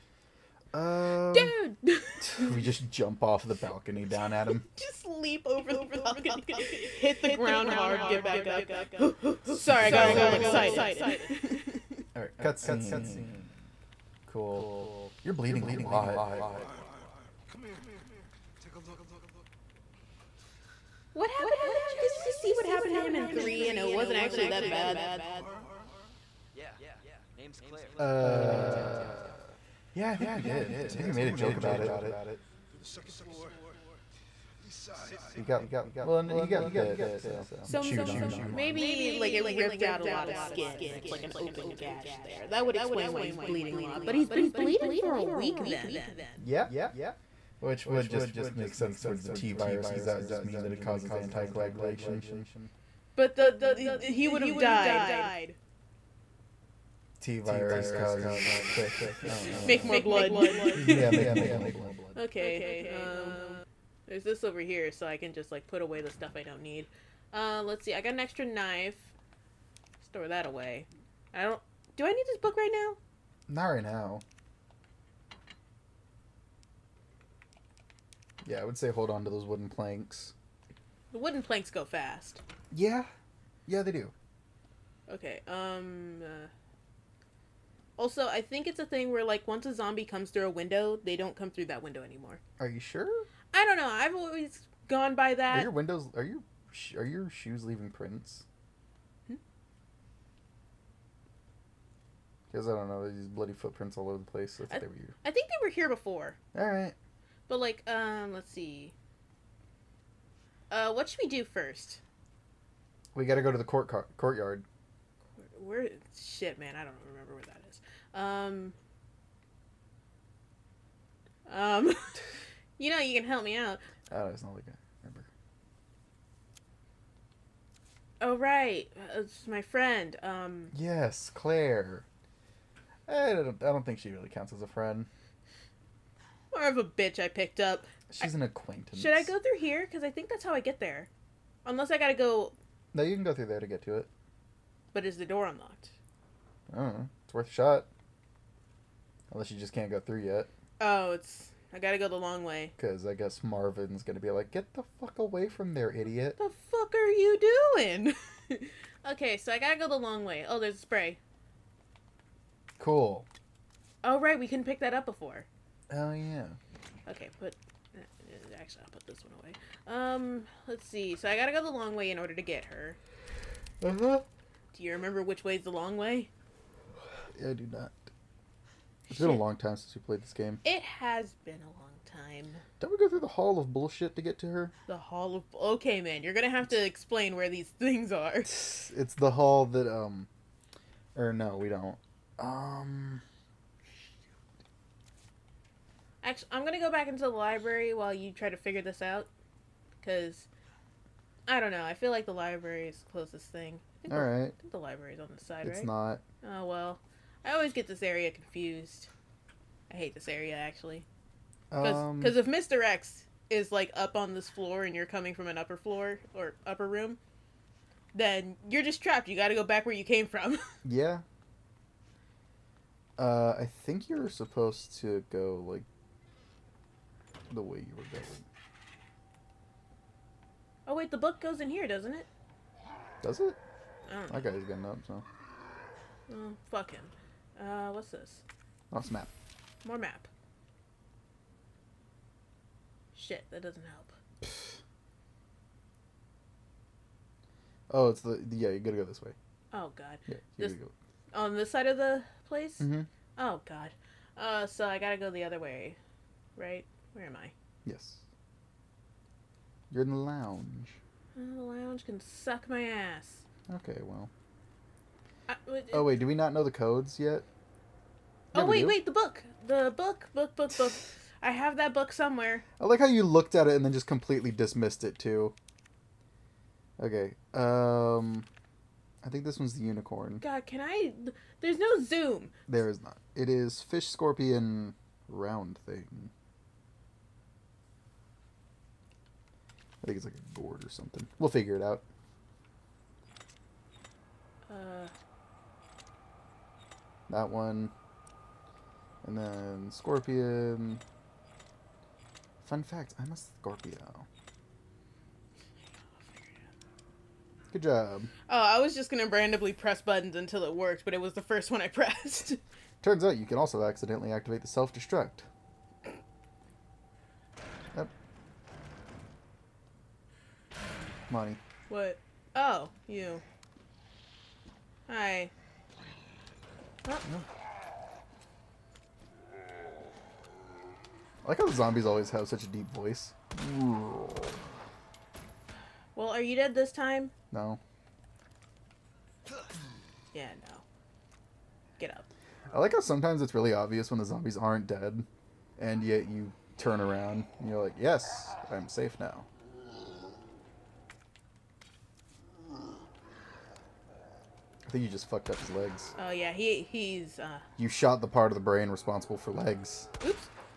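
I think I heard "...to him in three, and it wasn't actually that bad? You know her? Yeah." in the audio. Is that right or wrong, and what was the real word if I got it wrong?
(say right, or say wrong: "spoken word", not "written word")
right.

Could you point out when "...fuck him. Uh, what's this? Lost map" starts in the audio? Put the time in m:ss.
3:56.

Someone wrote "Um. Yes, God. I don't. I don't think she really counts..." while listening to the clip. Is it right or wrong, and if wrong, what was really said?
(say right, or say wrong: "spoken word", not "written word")
wrong: "Claire", not "God".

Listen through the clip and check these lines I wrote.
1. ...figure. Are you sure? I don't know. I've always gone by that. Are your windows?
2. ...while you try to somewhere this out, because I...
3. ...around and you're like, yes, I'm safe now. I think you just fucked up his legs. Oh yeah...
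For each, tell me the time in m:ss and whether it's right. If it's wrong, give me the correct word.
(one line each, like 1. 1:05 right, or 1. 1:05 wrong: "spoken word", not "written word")
1. 1:32 wrong: "anymore", not "figure"
2. 3:17 wrong: "figure", not "somewhere"
3. 5:47 right.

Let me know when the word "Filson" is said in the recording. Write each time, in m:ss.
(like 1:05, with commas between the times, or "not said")
not said.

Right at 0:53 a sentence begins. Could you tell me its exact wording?
But the, the he would have died T virus causes make more blood.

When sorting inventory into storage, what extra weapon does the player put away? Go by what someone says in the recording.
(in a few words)
Knife.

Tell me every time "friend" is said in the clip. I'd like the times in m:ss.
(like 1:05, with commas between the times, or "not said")
2:09, 2:14.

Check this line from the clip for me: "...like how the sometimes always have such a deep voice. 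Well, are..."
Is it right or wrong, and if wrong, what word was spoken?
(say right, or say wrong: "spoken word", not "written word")
wrong: "zombies", not "sometimes".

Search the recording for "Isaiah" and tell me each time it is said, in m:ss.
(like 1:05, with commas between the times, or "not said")
not said.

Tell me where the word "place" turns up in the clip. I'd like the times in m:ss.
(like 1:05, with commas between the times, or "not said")
1:44, 4:12.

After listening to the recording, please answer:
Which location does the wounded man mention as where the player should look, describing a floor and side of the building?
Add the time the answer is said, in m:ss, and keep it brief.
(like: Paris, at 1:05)
Second floor, east side, at 0:32.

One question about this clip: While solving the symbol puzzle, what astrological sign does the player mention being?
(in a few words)
Scorpio.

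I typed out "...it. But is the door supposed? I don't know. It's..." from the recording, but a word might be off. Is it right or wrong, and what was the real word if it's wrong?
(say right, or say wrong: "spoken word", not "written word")
wrong: "unlocked", not "supposed".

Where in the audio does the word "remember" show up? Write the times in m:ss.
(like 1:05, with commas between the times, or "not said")
1:57, 2:05, 2:54.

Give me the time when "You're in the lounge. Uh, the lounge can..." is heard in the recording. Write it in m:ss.
4:19.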